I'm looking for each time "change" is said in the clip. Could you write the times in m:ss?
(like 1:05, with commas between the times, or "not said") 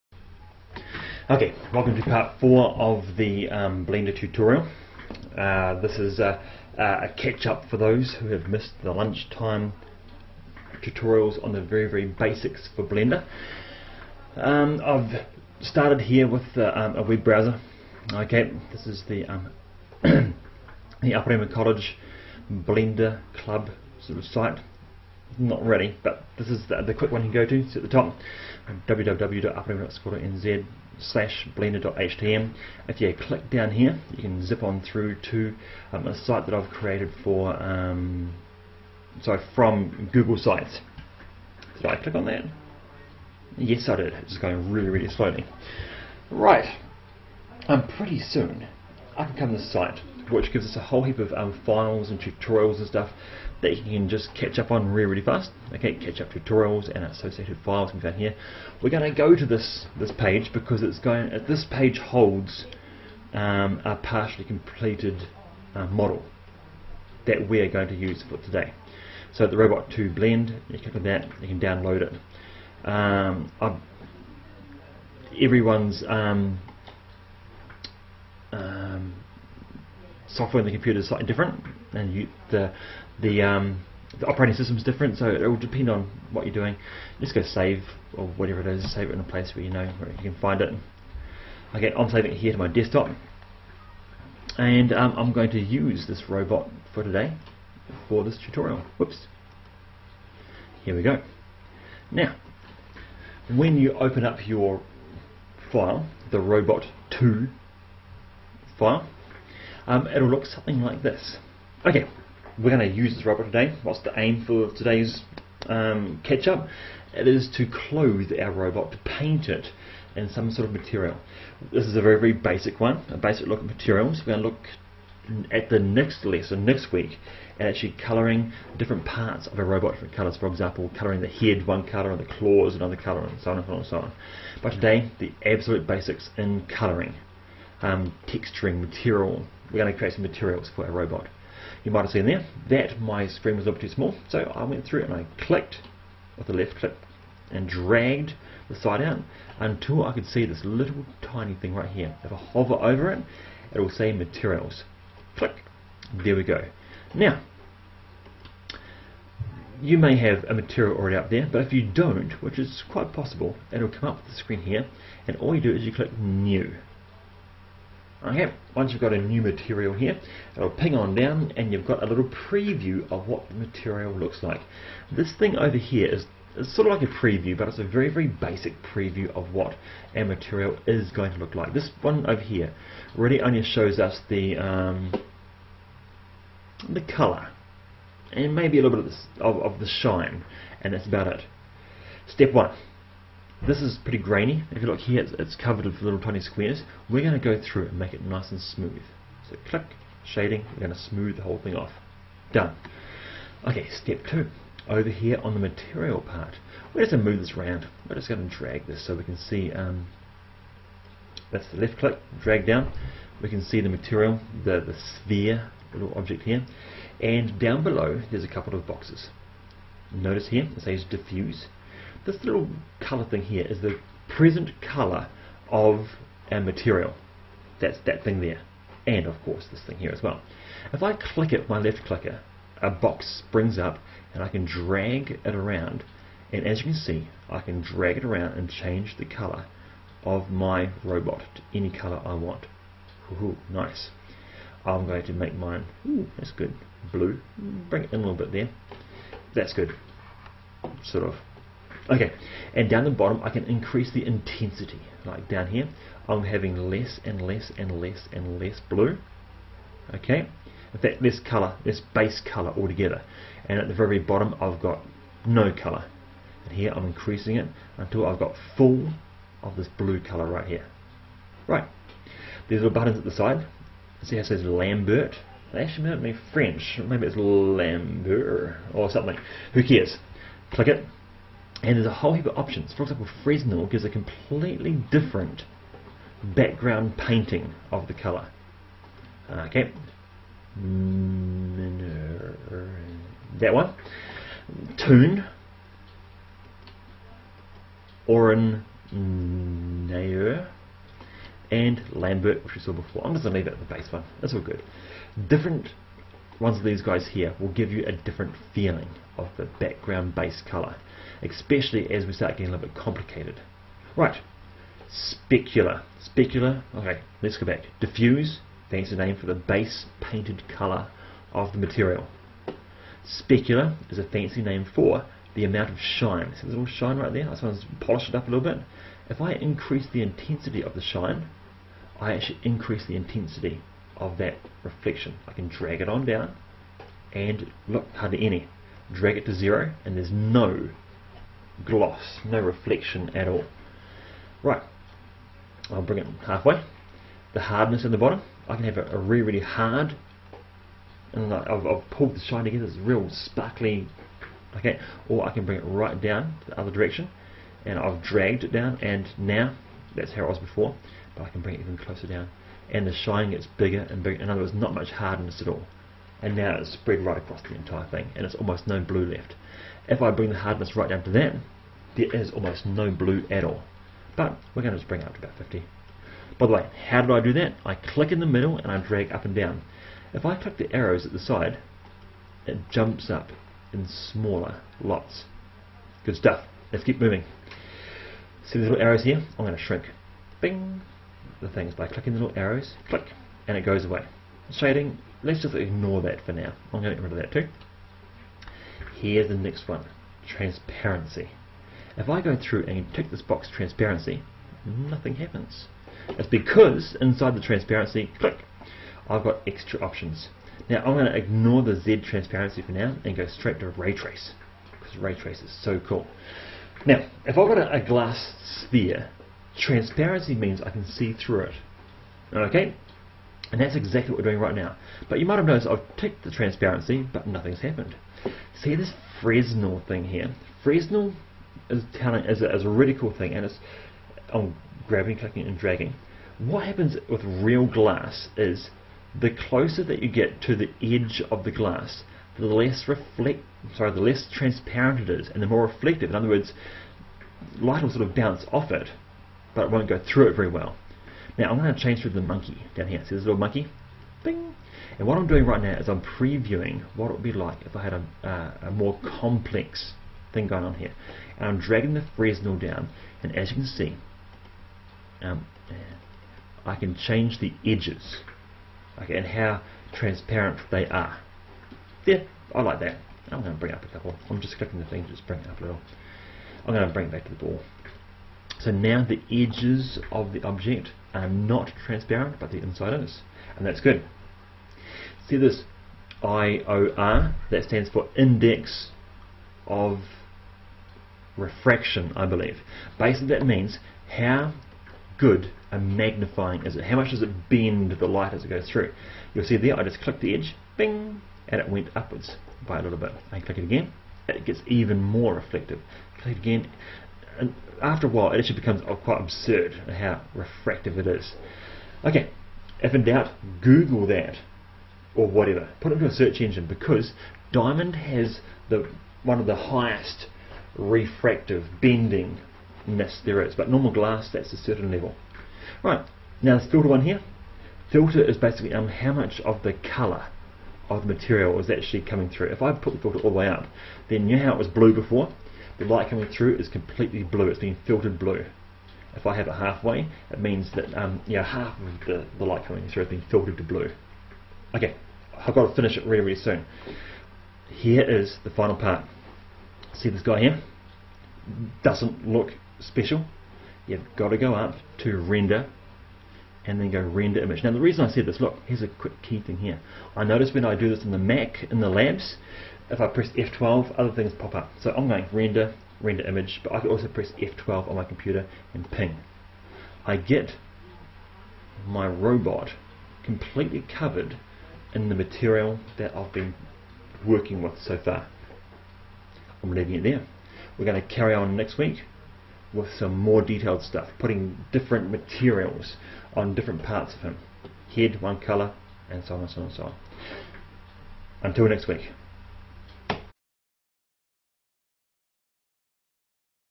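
3:58, 7:31, 7:47.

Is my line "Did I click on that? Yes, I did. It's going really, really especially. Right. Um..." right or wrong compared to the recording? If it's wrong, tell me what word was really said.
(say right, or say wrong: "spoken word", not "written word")
wrong: "slowly", not "especially".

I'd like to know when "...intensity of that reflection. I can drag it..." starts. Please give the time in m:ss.
5:33.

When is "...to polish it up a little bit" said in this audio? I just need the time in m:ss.
5:27.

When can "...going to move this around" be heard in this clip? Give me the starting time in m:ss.
3:27.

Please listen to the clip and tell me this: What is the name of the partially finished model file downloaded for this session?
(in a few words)
Robot 2 Blend.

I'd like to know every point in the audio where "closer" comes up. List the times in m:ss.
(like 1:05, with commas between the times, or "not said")
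6:01, 7:19.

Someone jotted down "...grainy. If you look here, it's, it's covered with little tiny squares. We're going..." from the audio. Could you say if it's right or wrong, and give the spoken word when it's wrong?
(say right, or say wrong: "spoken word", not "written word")
right.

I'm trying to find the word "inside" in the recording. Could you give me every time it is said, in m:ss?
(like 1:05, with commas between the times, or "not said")
6:47, 8:02.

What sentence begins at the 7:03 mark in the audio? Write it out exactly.
And that's exactly what we're doing right now.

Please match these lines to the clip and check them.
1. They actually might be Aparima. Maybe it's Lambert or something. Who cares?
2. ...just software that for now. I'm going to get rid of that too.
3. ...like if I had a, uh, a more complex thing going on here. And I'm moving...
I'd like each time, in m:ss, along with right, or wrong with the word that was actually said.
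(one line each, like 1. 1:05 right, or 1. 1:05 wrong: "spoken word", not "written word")
1. 4:35 wrong: "French", not "Aparima"
2. 6:35 wrong: "ignore", not "software"
3. 7:37 wrong: "dragging", not "moving".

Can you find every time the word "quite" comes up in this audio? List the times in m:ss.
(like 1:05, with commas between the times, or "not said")
2:42, 8:29.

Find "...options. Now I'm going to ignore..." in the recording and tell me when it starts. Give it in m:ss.
6:50.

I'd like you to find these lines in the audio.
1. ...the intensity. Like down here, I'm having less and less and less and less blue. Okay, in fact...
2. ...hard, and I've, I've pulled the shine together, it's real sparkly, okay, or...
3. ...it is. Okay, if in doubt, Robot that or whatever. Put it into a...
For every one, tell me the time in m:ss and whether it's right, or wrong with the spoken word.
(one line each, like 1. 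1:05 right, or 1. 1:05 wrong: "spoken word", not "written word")
1. 4:14 right
2. 5:49 right
3. 8:31 wrong: "Google", not "Robot".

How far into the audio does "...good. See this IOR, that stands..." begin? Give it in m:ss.
8:04.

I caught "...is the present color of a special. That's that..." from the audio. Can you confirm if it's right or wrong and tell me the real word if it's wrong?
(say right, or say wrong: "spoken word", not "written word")
wrong: "material", not "special".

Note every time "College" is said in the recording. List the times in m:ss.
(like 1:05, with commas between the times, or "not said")
0:21.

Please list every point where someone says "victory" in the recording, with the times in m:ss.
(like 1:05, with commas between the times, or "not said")
not said.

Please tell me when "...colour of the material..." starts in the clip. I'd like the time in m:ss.
8:49.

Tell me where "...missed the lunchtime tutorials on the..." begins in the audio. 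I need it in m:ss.
0:08.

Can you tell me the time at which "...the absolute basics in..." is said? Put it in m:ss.
2:15.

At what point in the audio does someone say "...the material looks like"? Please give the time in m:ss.
2:53.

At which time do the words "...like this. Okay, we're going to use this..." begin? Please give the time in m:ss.
1:50.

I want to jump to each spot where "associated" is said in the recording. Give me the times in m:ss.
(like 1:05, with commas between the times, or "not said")
0:57.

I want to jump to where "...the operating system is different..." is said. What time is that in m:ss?
1:24.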